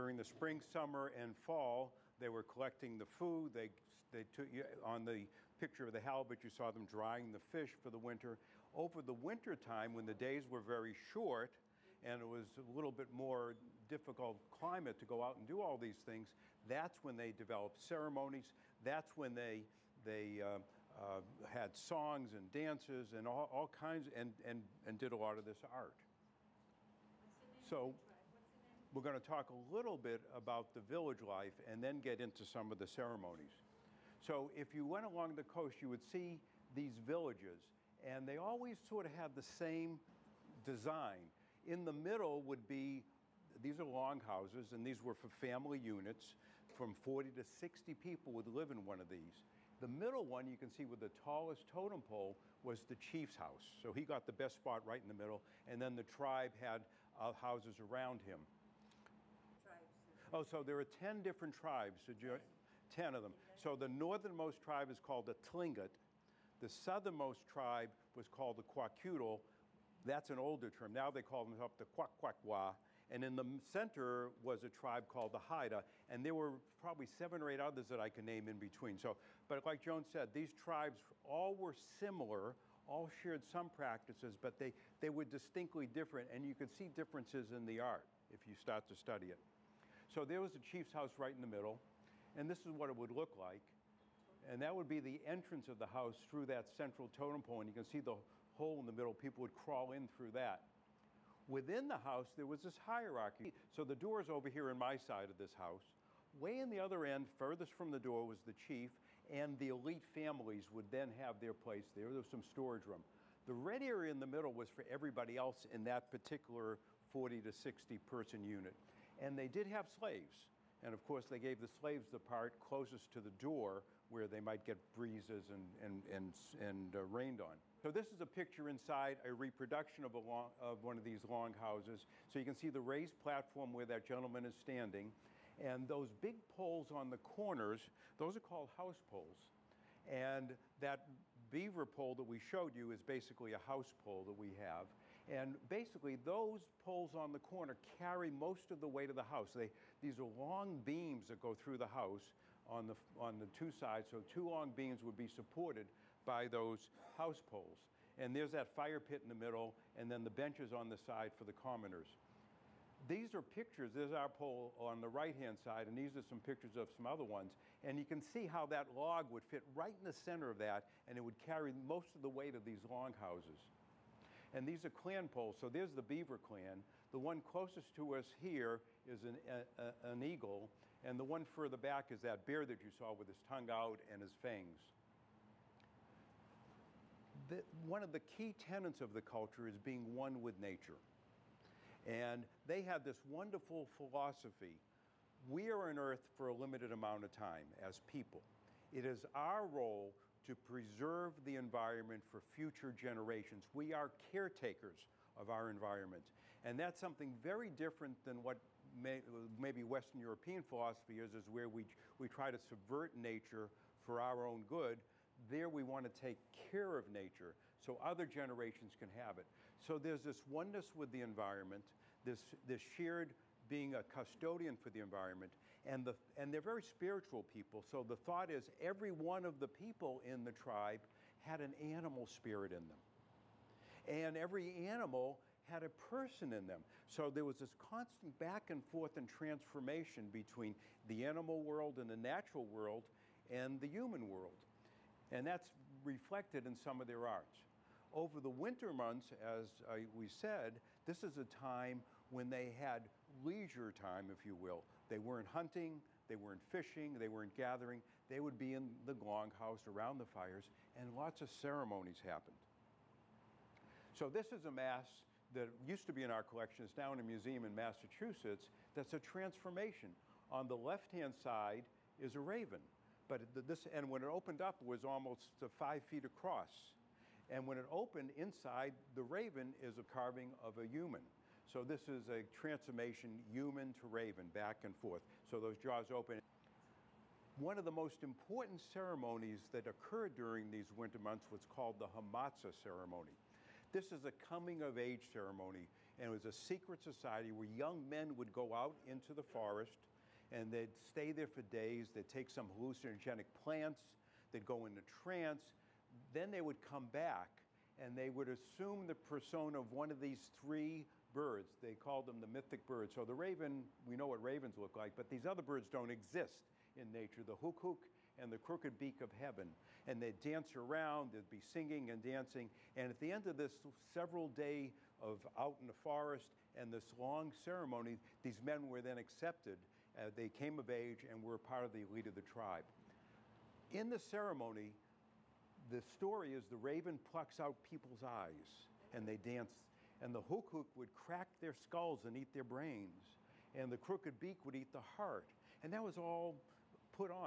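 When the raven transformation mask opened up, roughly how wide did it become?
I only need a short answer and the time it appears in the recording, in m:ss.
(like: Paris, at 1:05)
5 feet, at 4:35.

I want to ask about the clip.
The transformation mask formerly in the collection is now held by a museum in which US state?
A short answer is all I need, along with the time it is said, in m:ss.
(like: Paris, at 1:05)
Massachusetts, at 4:27.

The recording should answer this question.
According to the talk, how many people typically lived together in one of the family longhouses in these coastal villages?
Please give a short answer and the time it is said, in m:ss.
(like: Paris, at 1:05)
40 to 60, at 0:46.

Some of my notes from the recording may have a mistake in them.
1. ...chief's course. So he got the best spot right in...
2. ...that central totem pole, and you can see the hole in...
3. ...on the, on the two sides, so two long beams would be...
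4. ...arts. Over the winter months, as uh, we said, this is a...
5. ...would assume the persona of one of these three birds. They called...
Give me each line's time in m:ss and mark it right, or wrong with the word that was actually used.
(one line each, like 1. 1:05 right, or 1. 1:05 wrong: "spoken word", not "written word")
1. 0:52 wrong: "house", not "course"
2. 1:36 right
3. 2:32 right
4. 4:07 right
5. 5:08 right.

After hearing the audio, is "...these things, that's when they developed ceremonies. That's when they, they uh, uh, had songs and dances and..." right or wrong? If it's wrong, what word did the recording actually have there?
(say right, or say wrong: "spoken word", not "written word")
right.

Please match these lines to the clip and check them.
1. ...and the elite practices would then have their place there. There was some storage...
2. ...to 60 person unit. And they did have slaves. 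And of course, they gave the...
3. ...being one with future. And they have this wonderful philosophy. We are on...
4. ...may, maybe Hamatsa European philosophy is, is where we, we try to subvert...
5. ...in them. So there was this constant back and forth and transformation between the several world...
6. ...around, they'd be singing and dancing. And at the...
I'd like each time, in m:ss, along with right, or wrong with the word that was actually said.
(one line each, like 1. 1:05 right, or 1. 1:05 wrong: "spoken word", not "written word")
1. 1:49 wrong: "families", not "practices"
2. 1:57 right
3. 3:09 wrong: "nature", not "future"
4. 3:28 wrong: "Western", not "Hamatsa"
5. 3:56 wrong: "animal", not "several"
6. 5:20 right.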